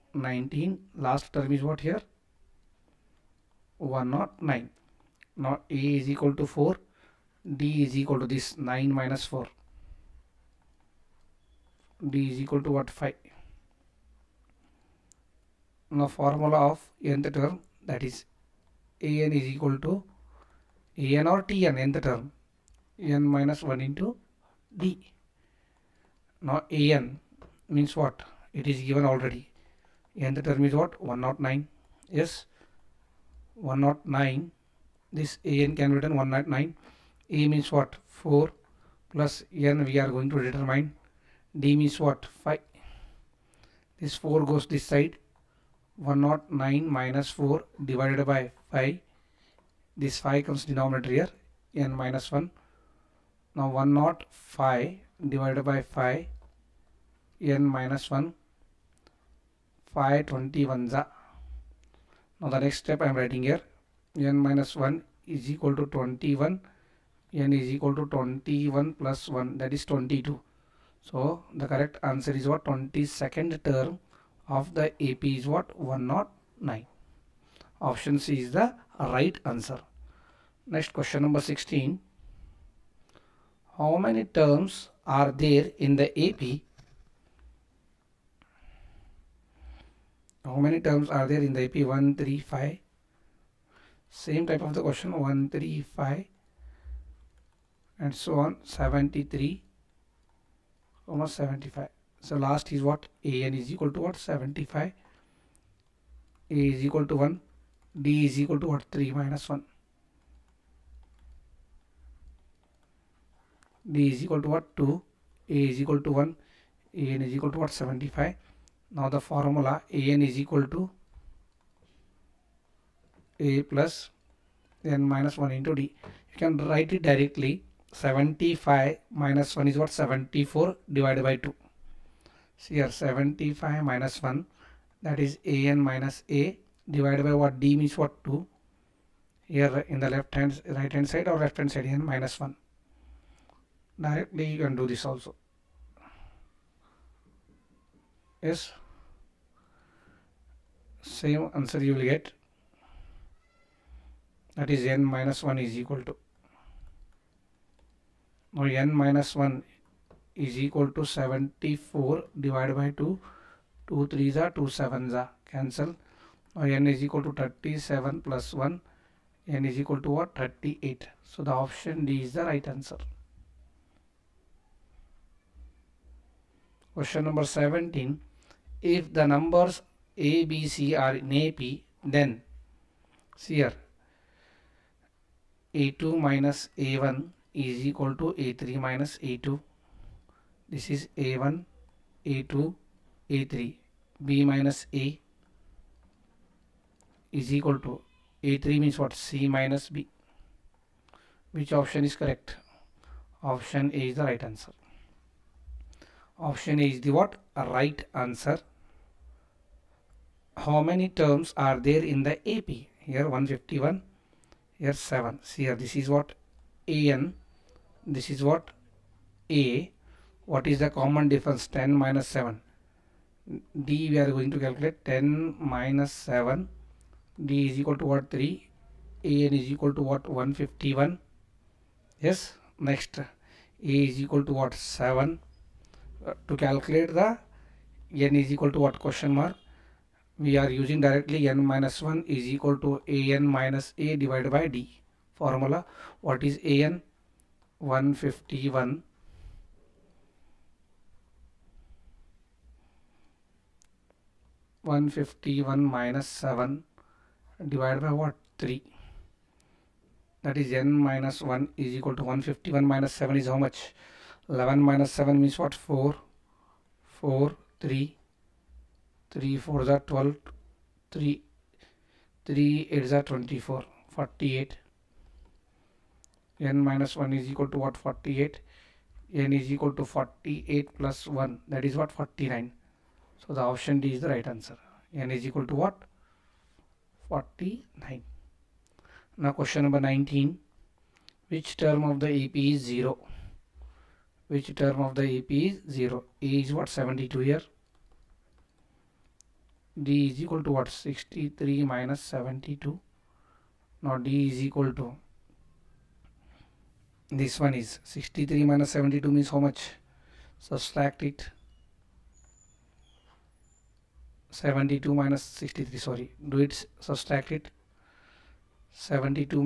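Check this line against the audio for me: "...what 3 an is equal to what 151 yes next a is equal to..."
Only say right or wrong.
right.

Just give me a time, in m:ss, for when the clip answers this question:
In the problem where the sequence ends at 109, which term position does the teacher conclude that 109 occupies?
1:12.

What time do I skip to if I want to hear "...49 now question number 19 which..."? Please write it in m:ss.
4:47.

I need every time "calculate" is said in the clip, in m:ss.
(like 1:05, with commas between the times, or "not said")
3:44, 3:56.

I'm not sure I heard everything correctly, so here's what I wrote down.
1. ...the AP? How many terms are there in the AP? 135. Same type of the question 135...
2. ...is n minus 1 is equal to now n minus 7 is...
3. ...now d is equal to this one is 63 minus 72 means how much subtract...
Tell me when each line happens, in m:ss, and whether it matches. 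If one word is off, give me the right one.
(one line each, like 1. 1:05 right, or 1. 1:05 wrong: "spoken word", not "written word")
1. 1:25 right
2. 2:34 wrong: "1", not "7"
3. 5:04 right.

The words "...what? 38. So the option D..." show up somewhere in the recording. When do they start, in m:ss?
2:50.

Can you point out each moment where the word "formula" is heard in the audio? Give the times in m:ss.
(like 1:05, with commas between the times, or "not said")
0:16, 1:59, 4:05.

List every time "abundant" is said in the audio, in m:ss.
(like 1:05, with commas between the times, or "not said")
not said.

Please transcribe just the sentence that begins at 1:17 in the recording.
Option C is the right answer.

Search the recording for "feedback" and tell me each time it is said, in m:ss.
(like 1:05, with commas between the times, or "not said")
not said.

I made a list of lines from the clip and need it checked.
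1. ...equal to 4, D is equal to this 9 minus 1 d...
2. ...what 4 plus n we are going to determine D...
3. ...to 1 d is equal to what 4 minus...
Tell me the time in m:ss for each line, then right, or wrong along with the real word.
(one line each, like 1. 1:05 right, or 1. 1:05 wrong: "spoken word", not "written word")
1. 0:06 wrong: "4", not "1"
2. 0:37 right
3. 1:47 wrong: "3", not "4".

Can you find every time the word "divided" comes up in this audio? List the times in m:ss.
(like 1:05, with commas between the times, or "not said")
0:47, 0:55, 2:10, 2:16, 2:42, 4:04.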